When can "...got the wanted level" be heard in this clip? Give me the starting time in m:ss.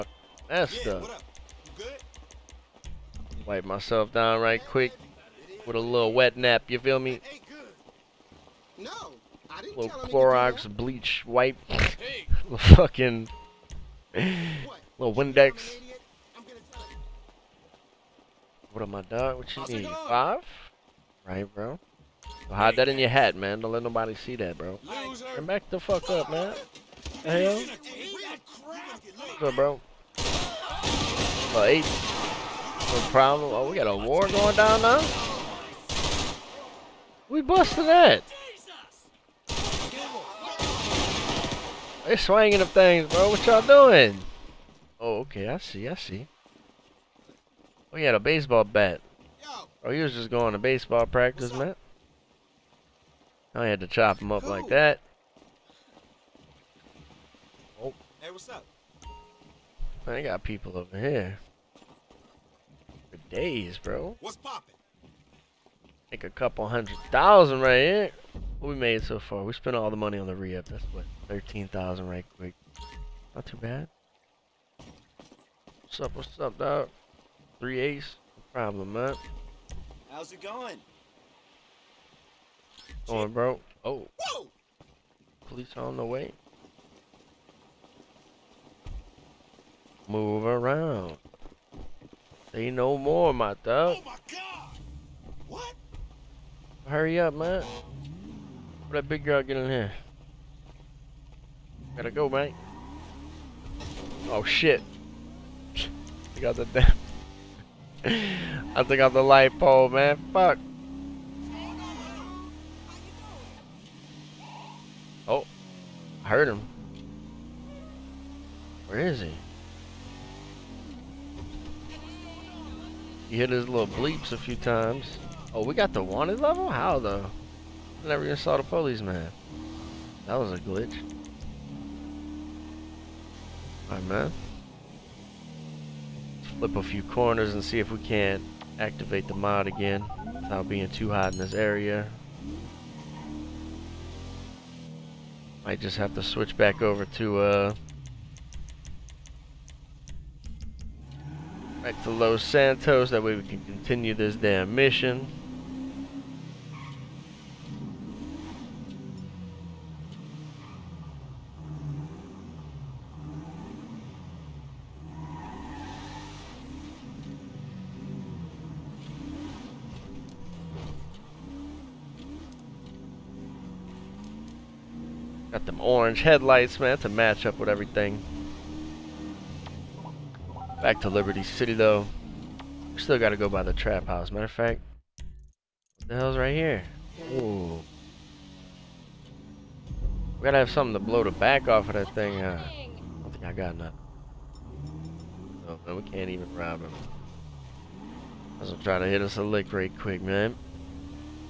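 2:05.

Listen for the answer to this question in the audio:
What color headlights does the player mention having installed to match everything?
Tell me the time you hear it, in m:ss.
2:55.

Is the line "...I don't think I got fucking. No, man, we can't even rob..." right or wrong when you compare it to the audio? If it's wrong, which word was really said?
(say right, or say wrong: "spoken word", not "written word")
wrong: "nothing", not "fucking".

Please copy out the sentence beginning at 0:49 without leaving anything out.
Oh, he was just going to baseball practice, man.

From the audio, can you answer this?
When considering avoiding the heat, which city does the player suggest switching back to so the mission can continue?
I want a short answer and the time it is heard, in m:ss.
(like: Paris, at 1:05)
Los Santos, at 2:32.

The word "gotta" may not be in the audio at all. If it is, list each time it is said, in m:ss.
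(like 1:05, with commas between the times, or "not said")
1:41, 3:03, 3:10.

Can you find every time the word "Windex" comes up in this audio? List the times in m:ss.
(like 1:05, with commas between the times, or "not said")
0:15.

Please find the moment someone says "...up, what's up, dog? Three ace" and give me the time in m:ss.
1:15.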